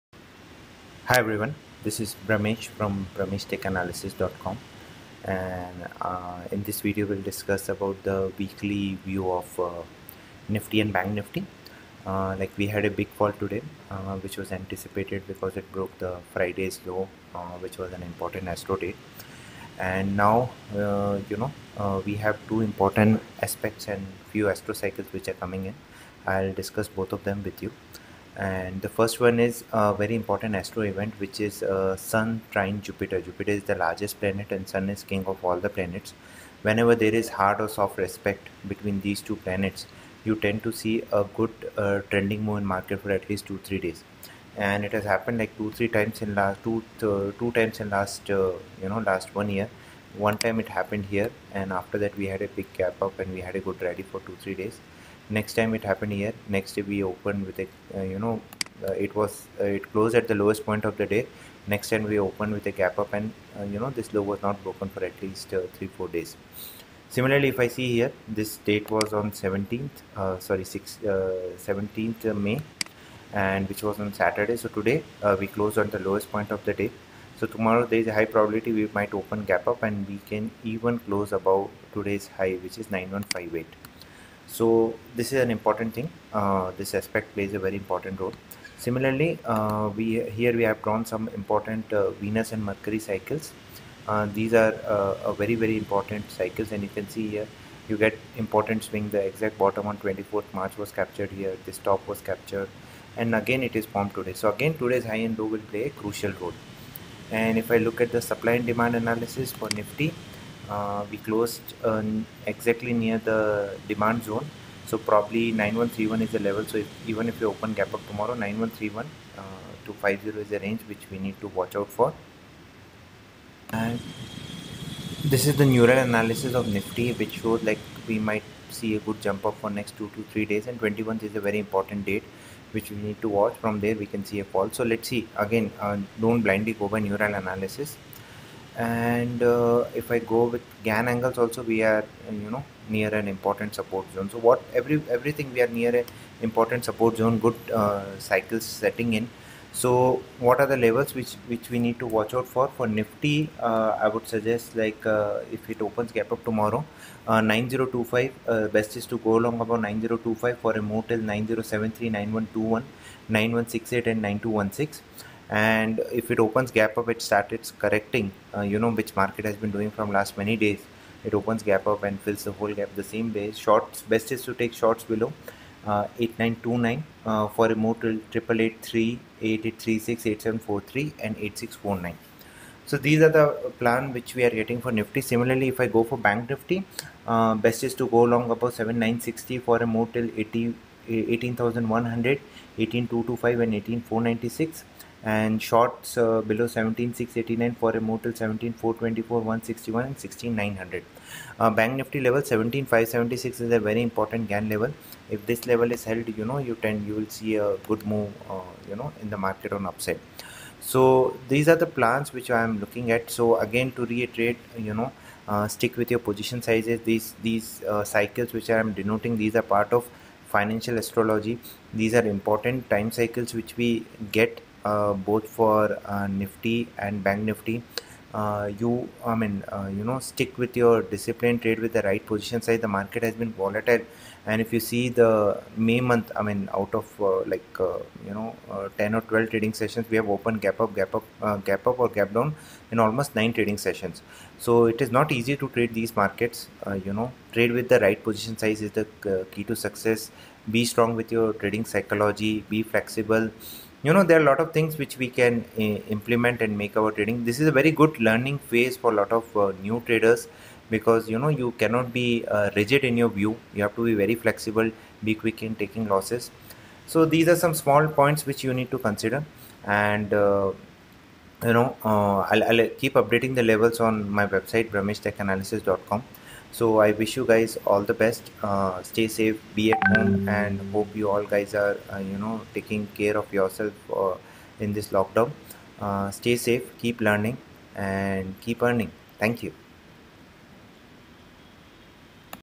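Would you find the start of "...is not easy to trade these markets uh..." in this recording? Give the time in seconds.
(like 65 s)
245 s.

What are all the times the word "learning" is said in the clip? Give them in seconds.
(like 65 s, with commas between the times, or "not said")
258 s, 287 s.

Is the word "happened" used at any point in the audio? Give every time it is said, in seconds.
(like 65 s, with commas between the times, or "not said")
45 s, 50 s, 55 s.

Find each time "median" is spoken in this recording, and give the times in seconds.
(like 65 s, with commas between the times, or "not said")
not said.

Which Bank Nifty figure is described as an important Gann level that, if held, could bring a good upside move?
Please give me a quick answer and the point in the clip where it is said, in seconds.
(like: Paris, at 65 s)
17576, at 202 s.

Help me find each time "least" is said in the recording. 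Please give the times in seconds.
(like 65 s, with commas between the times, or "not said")
43 s, 65 s.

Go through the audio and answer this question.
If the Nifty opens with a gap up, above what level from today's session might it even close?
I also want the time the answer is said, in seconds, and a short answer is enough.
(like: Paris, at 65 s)
9158, at 82 s.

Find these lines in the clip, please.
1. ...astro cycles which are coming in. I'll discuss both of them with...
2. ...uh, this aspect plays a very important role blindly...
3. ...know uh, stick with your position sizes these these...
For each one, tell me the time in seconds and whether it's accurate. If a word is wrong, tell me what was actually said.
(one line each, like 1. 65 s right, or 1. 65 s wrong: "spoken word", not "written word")
1. 24 s right
2. 86 s wrong: "similarly", not "blindly"
3. 214 s right.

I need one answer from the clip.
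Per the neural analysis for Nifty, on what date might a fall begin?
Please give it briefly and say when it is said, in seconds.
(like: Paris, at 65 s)
21, at 130 s.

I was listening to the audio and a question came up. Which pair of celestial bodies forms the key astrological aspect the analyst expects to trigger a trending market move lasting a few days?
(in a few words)
Sun trine Jupiter.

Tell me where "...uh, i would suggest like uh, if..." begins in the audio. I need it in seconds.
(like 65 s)
153 s.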